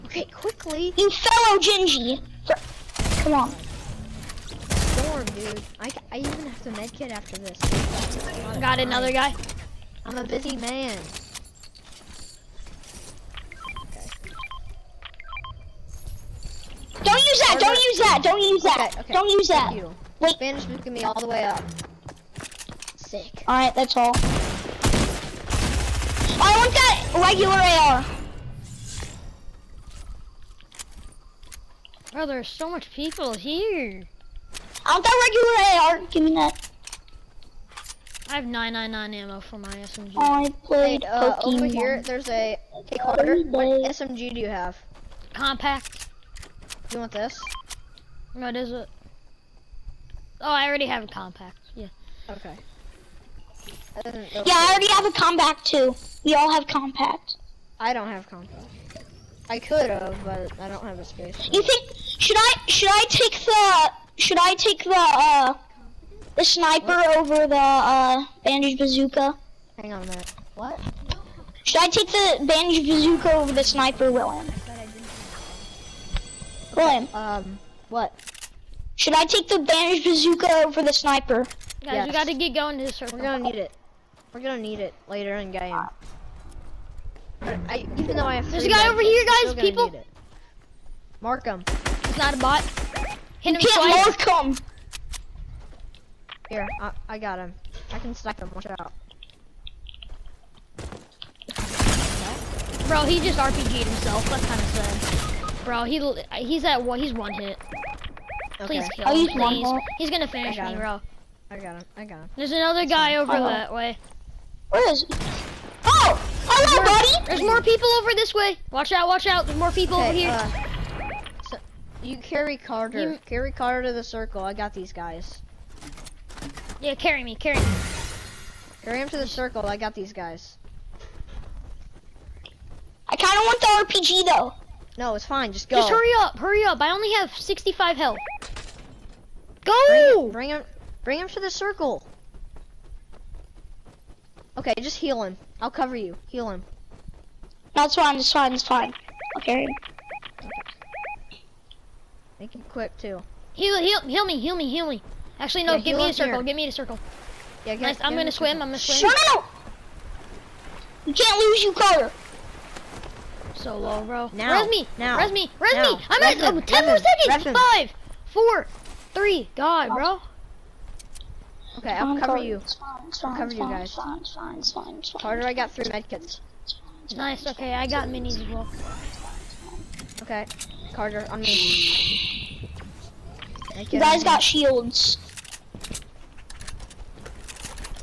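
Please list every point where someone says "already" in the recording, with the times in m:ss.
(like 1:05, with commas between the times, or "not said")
0:50, 0:54.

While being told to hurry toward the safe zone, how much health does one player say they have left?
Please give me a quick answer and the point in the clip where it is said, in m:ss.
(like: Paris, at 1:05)
65, at 2:17.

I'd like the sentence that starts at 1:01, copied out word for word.
You think should I should I take the should I take the uh the sniper what?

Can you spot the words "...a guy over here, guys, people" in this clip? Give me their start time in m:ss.
1:28.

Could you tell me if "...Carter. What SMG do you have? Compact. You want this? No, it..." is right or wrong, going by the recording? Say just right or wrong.
right.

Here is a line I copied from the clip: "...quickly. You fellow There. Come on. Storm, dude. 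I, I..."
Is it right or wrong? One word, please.
wrong.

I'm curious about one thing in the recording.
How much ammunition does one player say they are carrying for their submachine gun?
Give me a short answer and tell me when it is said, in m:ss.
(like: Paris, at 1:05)
999, at 0:38.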